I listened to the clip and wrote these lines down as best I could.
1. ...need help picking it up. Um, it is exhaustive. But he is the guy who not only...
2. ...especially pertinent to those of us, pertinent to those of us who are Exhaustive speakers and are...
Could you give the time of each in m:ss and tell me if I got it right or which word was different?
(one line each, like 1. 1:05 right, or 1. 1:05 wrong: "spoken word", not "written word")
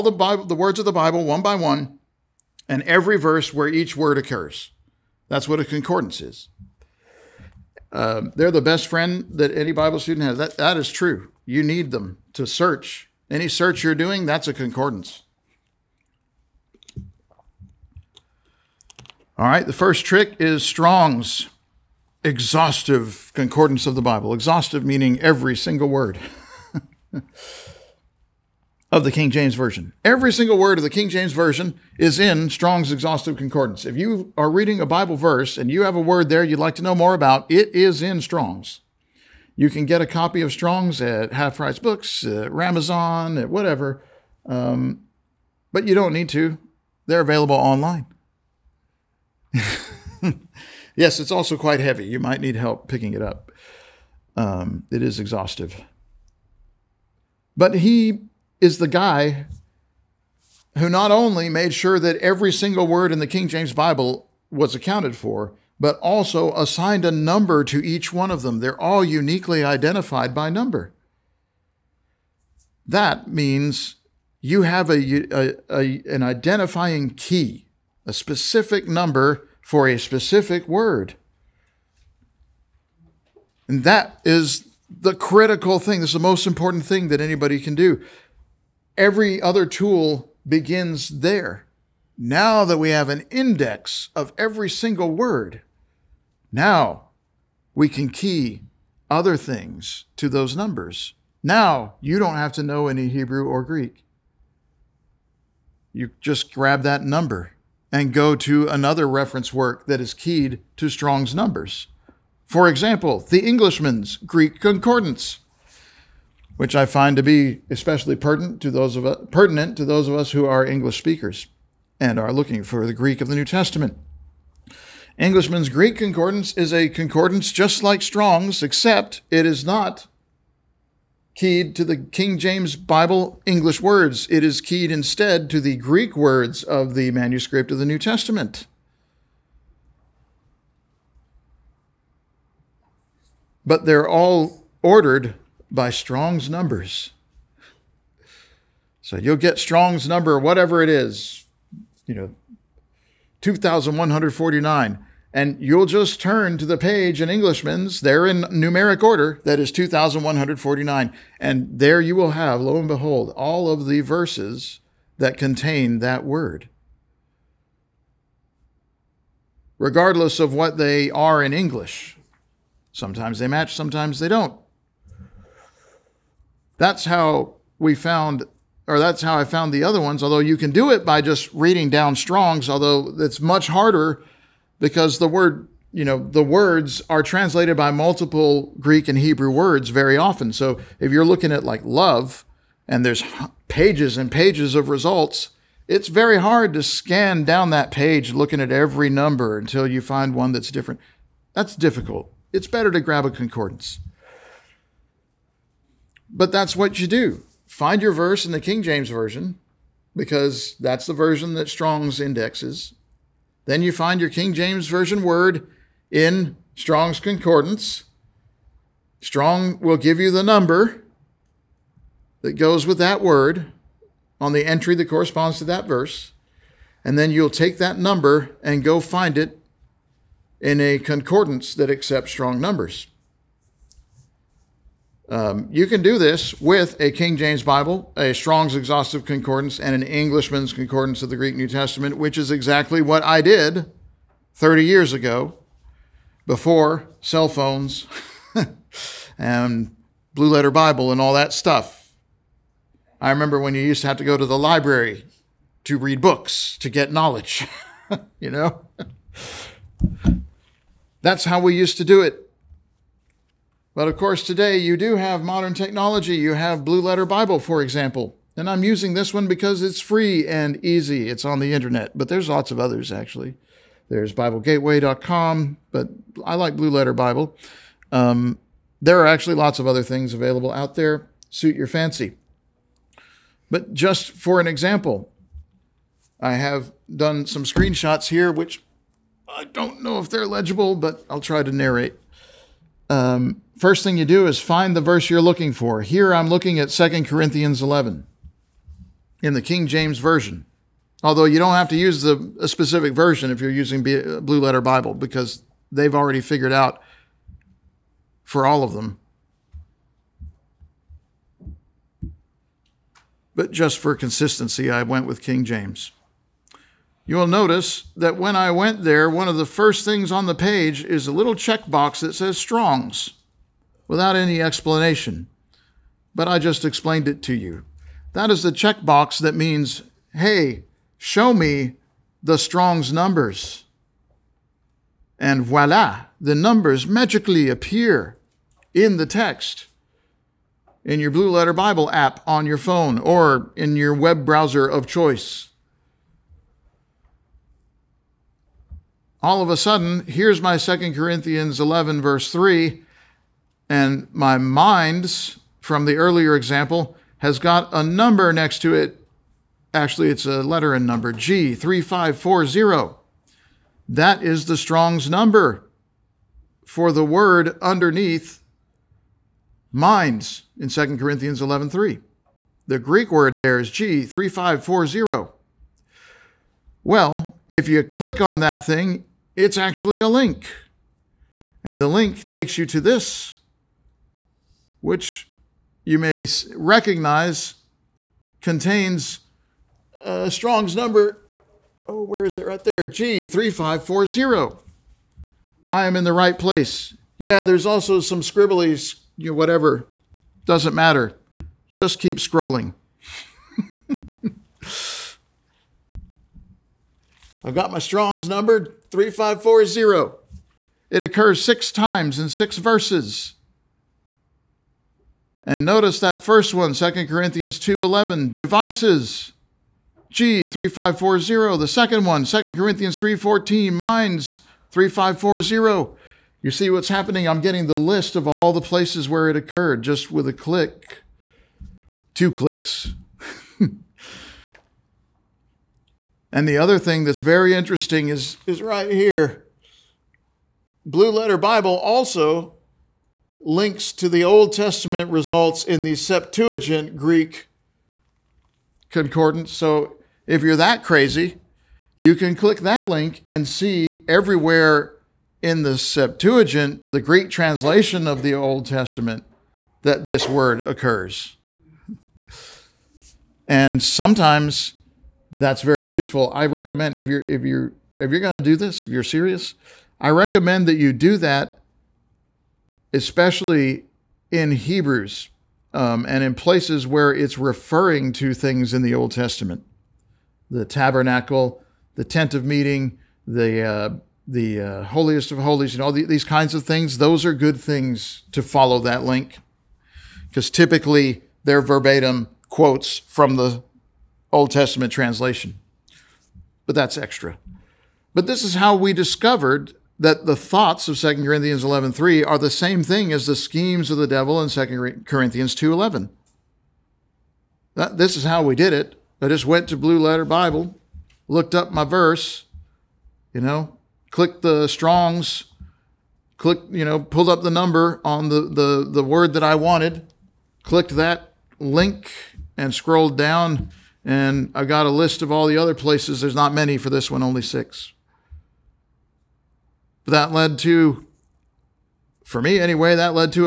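1. 0:52 right
2. 1:57 wrong: "English", not "Exhaustive".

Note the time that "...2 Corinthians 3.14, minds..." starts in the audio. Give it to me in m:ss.
7:02.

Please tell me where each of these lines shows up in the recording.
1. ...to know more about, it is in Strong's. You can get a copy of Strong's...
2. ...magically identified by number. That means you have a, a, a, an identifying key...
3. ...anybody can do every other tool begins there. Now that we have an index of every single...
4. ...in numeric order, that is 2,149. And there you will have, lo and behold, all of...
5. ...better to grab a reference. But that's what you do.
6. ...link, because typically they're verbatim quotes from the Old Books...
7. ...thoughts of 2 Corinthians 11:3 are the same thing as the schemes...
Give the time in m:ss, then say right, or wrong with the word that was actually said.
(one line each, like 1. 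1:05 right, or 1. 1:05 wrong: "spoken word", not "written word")
1. 0:36 right
2. 1:09 wrong: "uniquely", not "magically"
3. 1:27 right
4. 2:38 right
5. 3:22 wrong: "concordance", not "reference"
6. 8:09 wrong: "Testament", not "Books"
7. 8:20 right.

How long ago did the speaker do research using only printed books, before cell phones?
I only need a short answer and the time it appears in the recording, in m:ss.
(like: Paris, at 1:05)
30 years, at 4:04.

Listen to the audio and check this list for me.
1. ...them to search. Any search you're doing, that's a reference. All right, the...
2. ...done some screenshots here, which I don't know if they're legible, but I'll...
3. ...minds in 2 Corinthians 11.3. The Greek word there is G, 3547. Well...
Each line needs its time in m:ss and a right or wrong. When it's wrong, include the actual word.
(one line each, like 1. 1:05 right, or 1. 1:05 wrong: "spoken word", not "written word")
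1. 0:11 wrong: "concordance", not "reference"
2. 4:47 right
3. 6:09 wrong: "3540", not "3547".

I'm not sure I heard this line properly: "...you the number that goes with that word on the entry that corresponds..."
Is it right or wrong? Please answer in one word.
right.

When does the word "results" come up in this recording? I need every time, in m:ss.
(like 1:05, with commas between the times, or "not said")
3:14, 7:25.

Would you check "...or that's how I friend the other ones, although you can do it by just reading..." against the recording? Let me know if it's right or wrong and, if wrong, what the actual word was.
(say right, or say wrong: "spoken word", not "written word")
wrong: "found", not "friend".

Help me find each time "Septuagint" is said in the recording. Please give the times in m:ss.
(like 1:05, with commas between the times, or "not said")
7:26, 7:35.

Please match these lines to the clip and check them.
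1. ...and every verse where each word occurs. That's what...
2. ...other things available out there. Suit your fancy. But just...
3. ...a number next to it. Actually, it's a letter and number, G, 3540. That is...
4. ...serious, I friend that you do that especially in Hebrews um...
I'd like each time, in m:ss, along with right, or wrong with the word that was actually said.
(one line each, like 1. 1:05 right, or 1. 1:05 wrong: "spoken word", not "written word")
1. 0:02 right
2. 4:39 right
3. 5:57 right
4. 7:49 wrong: "recommend", not "friend".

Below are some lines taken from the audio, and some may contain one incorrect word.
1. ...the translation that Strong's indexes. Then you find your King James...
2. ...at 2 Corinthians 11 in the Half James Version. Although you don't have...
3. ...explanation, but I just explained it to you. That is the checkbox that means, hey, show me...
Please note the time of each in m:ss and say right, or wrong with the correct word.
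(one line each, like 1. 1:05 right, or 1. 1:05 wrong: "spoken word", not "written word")
1. 3:31 wrong: "version", not "translation"
2. 4:56 wrong: "King", not "Half"
3. 5:24 right.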